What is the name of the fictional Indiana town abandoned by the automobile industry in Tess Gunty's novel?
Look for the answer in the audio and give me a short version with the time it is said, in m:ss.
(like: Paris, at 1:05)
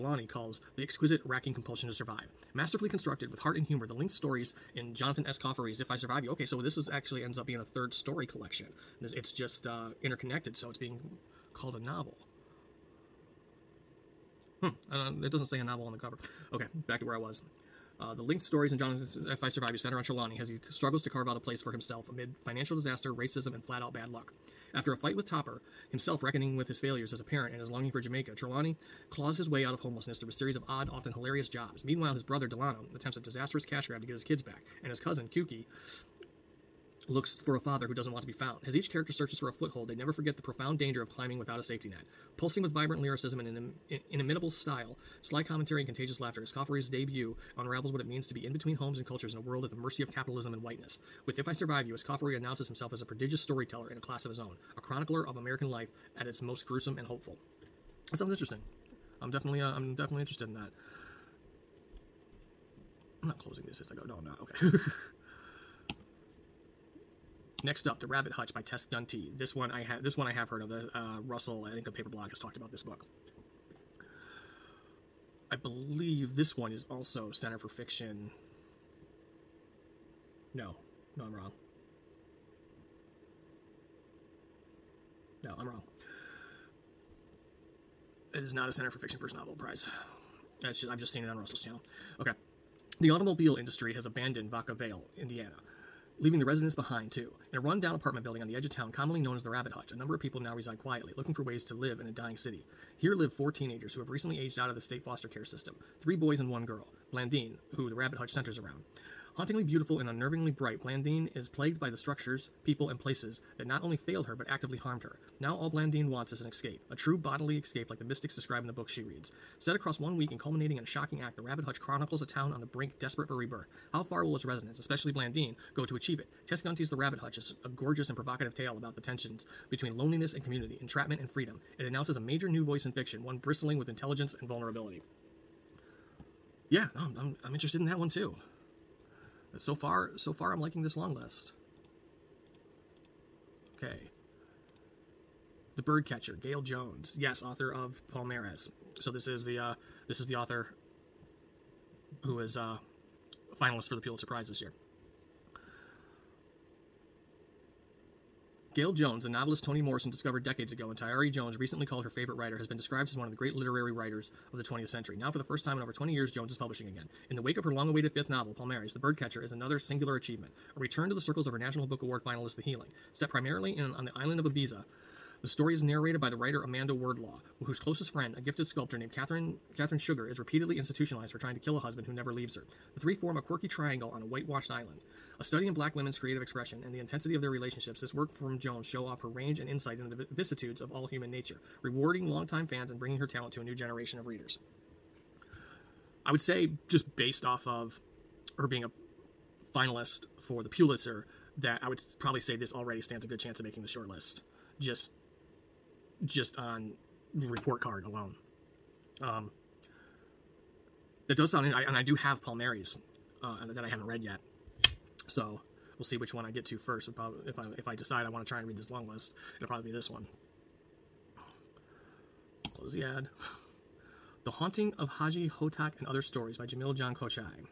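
Vaca Vale, at 1:34.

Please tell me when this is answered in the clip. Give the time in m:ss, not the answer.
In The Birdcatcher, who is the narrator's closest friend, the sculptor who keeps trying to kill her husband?
2:59.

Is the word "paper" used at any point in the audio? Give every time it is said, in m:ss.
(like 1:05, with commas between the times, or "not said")
1:11.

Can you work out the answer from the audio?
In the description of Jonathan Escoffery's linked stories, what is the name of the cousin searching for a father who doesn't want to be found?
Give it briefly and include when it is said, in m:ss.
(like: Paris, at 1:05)
Kuki, at 0:35.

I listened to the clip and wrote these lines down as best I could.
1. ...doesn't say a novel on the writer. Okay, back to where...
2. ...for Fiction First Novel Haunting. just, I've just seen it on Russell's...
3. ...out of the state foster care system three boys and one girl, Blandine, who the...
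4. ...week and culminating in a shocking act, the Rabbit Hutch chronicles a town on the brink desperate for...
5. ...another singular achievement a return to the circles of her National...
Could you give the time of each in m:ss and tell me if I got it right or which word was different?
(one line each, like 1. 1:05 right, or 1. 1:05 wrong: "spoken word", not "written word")
1. 0:15 wrong: "cover", not "writer"
2. 1:28 wrong: "Prize", not "Haunting"
3. 1:44 right
4. 2:00 right
5. 2:49 right.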